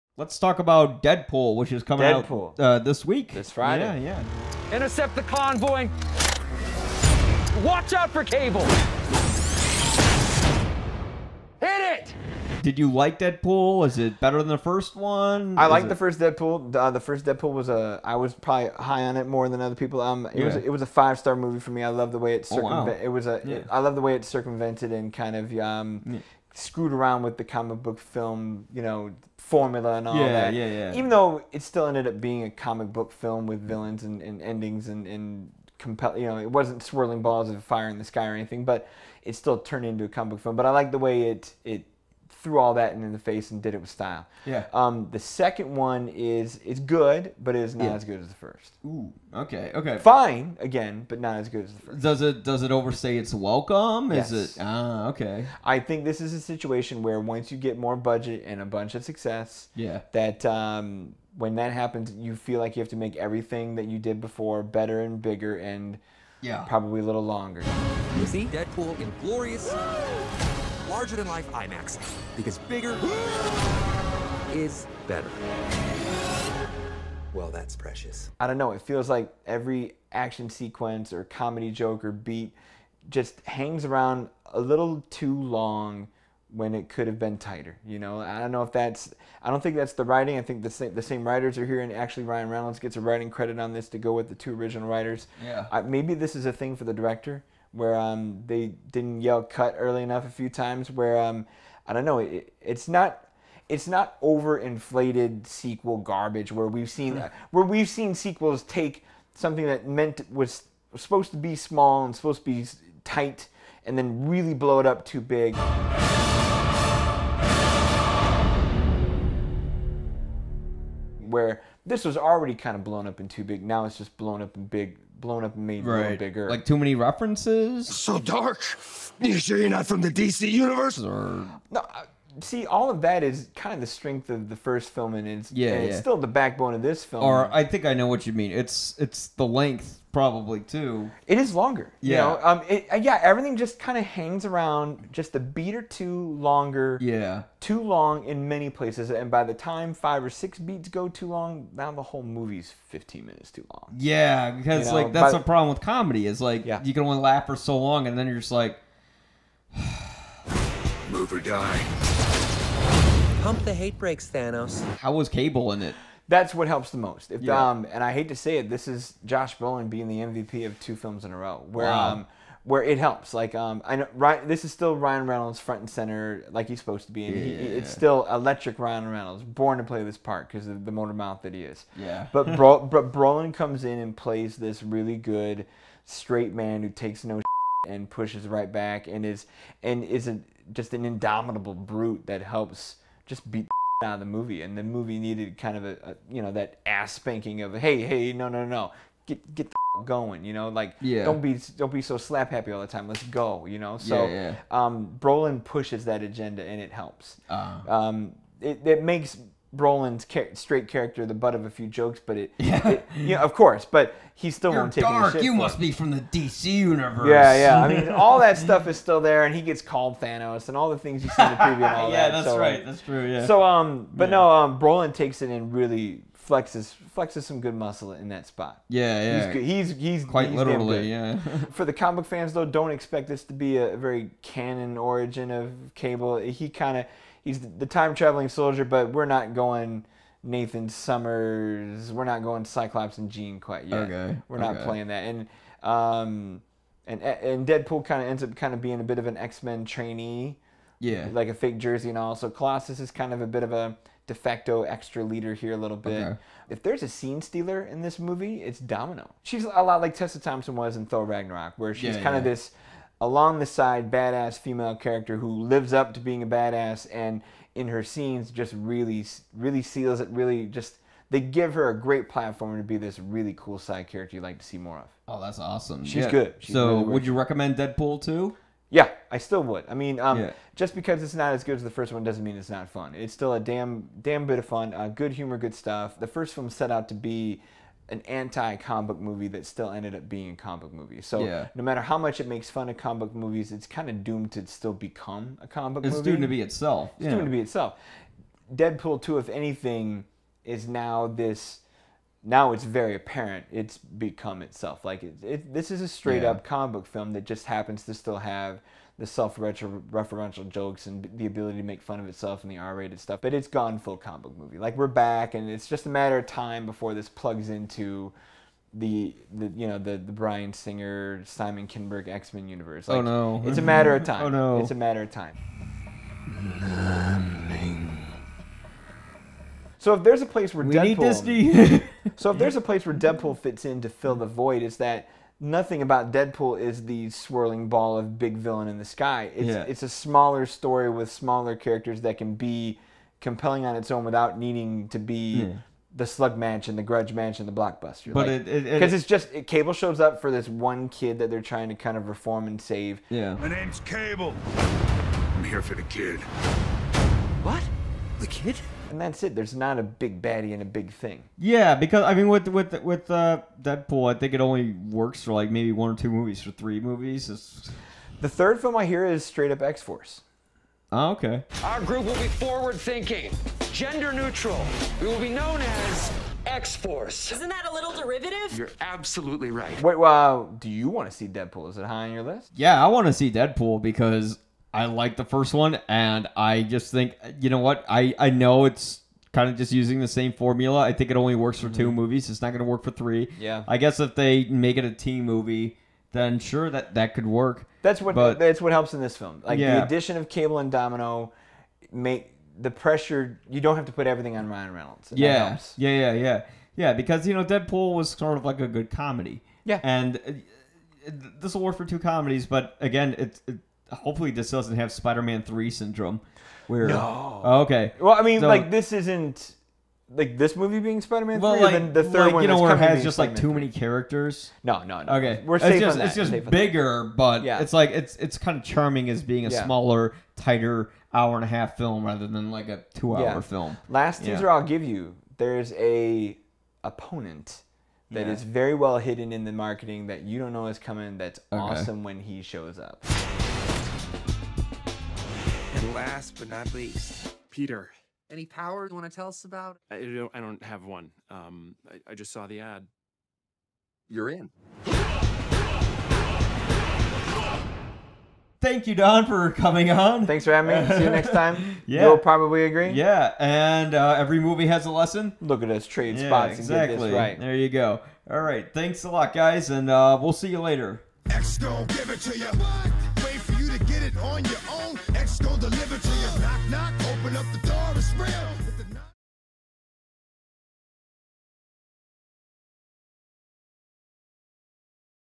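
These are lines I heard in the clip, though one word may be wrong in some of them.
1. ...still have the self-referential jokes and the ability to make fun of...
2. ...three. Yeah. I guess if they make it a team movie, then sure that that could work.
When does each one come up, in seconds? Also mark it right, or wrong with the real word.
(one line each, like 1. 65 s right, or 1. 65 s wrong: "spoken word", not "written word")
1. 308 s right
2. 393 s right.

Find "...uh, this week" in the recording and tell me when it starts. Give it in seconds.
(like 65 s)
2 s.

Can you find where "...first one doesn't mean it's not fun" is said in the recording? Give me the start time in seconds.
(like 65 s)
281 s.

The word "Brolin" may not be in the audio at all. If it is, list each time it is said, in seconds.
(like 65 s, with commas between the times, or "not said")
169 s, 182 s, 205 s, 209 s, 224 s.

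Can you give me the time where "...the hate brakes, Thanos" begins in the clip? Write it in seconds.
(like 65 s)
163 s.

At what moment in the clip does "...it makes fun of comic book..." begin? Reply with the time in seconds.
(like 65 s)
292 s.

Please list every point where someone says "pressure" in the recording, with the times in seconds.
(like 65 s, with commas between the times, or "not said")
402 s.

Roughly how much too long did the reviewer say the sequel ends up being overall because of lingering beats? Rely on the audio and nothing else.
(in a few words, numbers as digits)
15 minutes.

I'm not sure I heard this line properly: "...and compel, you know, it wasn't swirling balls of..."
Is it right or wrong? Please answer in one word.
right.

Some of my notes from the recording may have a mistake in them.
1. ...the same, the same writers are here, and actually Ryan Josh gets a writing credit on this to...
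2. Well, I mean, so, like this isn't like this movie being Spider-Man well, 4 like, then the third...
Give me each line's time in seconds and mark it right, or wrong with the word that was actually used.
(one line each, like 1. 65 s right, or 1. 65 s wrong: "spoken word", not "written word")
1. 90 s wrong: "Reynolds", not "Josh"
2. 418 s wrong: "3", not "4".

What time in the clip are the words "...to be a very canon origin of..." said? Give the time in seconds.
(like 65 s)
233 s.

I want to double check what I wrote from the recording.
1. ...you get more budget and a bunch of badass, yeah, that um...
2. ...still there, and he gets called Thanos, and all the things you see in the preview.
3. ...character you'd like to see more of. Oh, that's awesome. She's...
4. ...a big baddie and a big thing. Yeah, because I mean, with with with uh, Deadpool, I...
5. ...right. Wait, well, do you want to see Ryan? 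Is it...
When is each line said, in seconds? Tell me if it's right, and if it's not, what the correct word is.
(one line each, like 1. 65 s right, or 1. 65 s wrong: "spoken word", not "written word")
1. 57 s wrong: "success", not "badass"
2. 218 s right
3. 274 s right
4. 359 s right
5. 379 s wrong: "Deadpool", not "Ryan".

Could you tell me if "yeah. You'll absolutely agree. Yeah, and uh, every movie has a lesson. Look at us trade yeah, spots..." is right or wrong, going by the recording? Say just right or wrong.
wrong.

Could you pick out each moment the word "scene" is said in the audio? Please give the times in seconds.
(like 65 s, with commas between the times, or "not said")
257 s, 268 s.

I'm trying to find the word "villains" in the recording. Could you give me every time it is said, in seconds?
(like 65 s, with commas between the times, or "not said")
33 s, 338 s.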